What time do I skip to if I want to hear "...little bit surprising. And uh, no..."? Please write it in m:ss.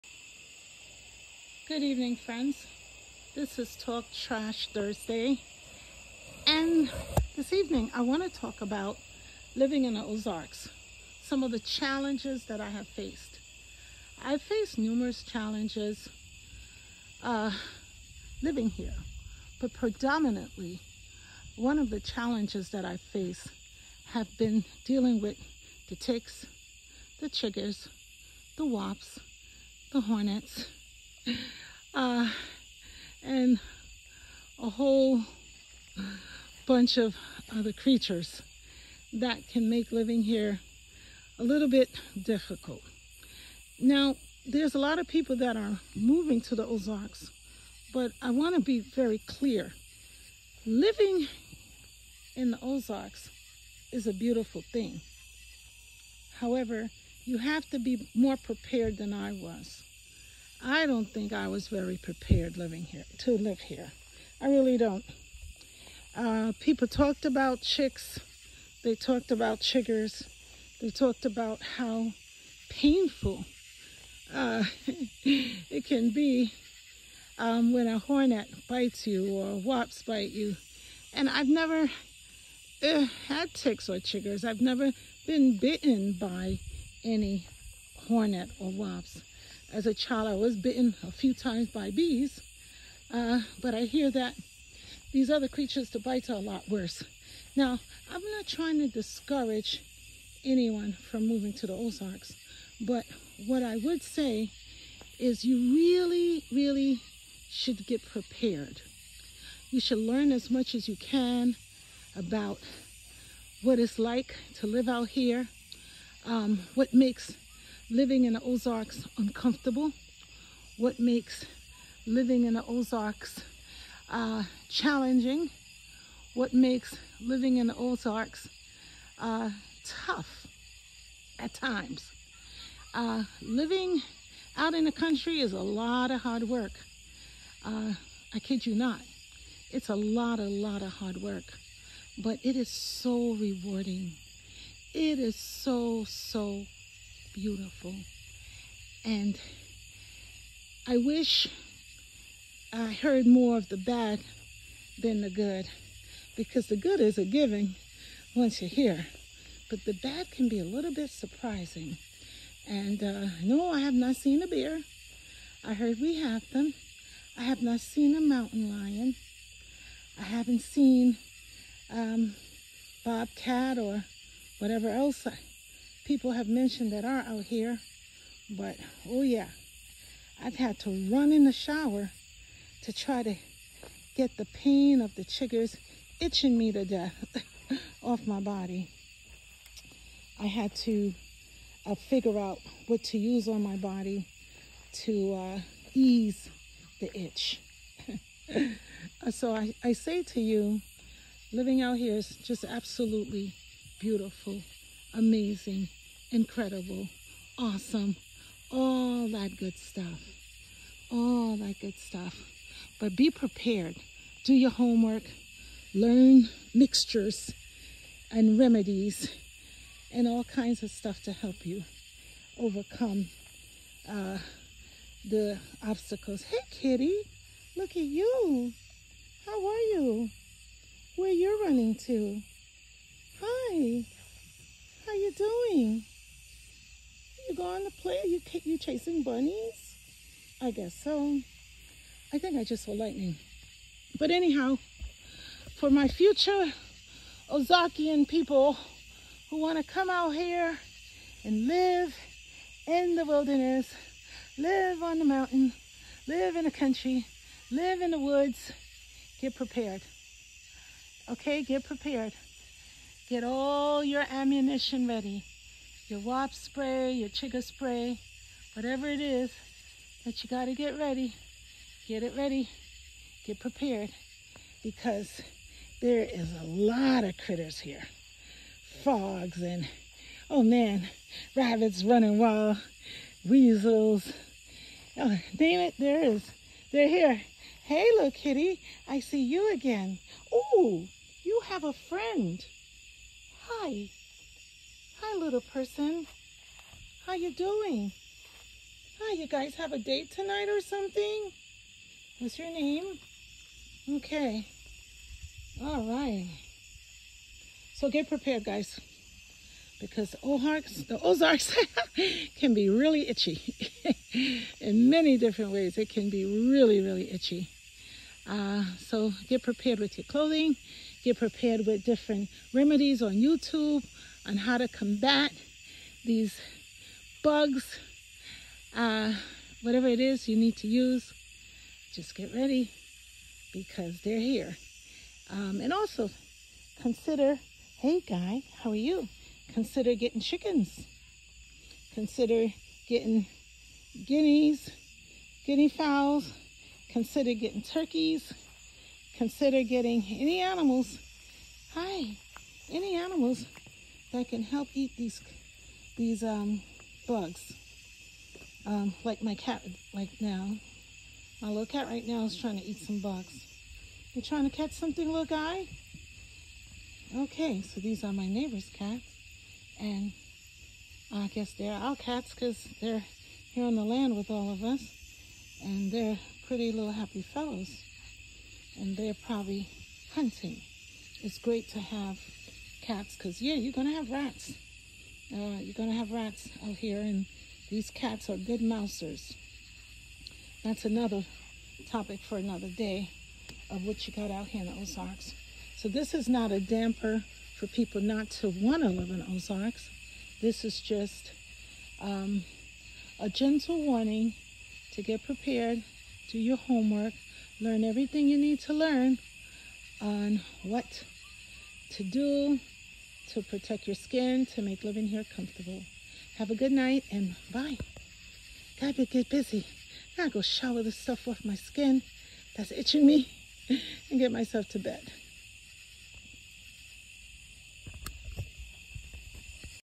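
2:40.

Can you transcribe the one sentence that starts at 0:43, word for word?
Now, there's a lot of people that are moving to the Ozarks, but I want to be very clear.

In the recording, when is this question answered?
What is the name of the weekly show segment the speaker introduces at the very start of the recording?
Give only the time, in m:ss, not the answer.
0:03.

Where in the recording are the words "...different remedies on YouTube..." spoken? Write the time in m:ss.
5:22.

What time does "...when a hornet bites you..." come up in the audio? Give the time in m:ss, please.
1:17.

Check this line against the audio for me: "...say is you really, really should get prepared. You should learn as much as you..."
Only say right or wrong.
right.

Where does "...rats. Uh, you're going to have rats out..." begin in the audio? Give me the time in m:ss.
6:24.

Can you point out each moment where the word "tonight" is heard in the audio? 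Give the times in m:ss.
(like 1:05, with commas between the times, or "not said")
5:00.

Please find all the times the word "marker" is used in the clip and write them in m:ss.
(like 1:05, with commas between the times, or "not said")
not said.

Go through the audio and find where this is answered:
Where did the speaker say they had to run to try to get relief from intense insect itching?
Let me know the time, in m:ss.
3:01.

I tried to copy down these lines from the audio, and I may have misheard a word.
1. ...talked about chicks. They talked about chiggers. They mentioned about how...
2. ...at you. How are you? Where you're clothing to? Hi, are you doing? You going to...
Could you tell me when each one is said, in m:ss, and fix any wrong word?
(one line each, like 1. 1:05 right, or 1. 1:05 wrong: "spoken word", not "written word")
1. 1:06 wrong: "talked", not "mentioned"
2. 3:47 wrong: "running", not "clothing".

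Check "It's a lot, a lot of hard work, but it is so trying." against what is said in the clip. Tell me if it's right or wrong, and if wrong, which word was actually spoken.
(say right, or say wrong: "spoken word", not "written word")
wrong: "rewarding", not "trying".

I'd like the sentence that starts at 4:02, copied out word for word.
I think I just saw lightning.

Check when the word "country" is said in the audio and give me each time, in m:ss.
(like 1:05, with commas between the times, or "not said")
2:14, 4:16.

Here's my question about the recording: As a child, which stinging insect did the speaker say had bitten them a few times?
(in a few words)
Bees.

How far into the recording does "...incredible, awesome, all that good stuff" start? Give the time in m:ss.
3:26.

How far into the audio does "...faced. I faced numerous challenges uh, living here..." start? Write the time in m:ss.
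0:12.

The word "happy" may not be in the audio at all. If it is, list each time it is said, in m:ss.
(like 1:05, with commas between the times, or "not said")
6:17.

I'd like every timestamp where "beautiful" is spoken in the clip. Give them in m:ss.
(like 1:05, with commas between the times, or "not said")
0:54, 2:27, 3:23.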